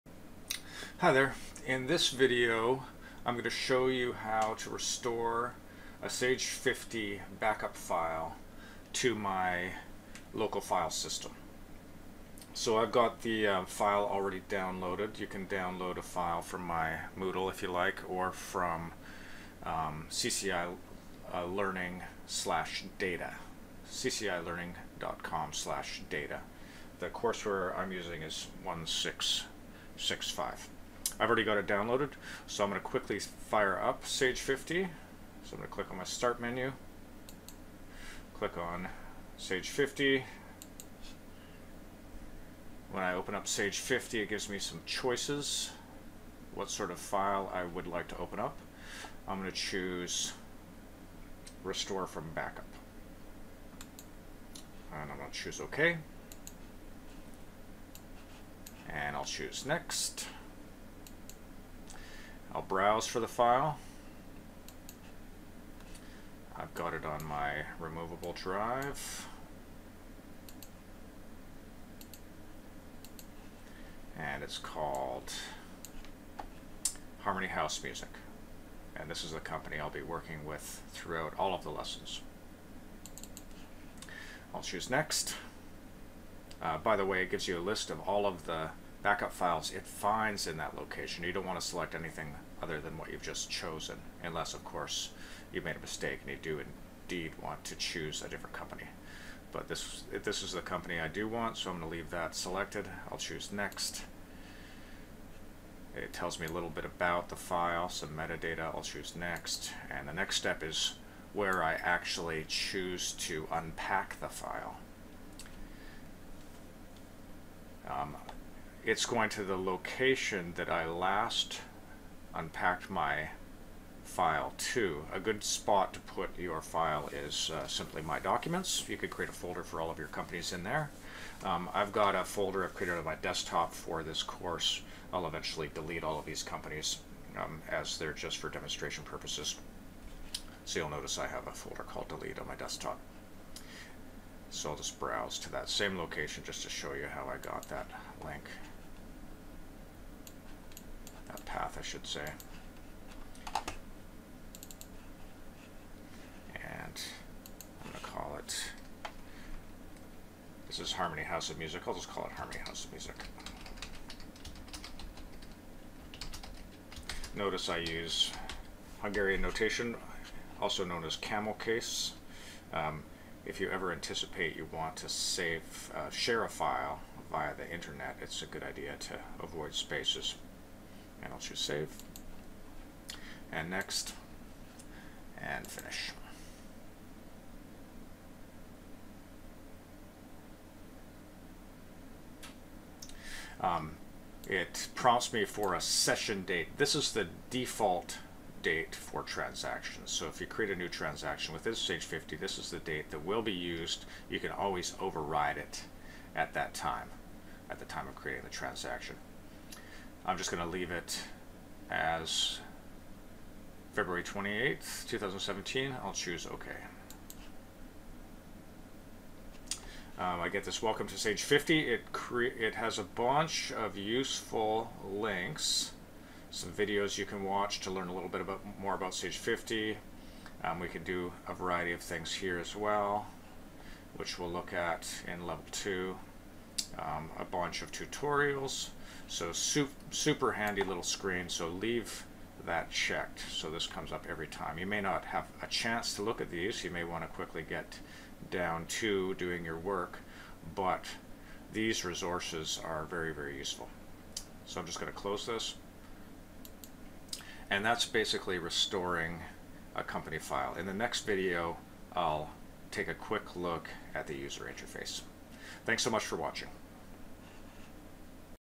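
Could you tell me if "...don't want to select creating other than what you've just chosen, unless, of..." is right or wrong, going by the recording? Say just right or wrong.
wrong.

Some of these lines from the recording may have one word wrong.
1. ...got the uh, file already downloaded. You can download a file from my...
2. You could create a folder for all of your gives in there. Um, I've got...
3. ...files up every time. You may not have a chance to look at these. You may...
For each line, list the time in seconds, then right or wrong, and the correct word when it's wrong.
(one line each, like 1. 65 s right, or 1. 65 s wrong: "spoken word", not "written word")
1. 12 s right
2. 128 s wrong: "companies", not "gives"
3. 243 s wrong: "comes", not "files".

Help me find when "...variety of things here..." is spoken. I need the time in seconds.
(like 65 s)
231 s.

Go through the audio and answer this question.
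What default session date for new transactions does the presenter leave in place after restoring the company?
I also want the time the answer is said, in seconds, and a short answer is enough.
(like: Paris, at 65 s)
February 28th, 2017, at 213 s.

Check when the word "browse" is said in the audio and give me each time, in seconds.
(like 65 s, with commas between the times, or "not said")
62 s, 144 s.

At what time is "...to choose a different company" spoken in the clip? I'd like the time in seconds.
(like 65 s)
97 s.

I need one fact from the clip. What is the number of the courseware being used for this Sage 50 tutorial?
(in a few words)
1665.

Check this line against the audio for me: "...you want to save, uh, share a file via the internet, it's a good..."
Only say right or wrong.
right.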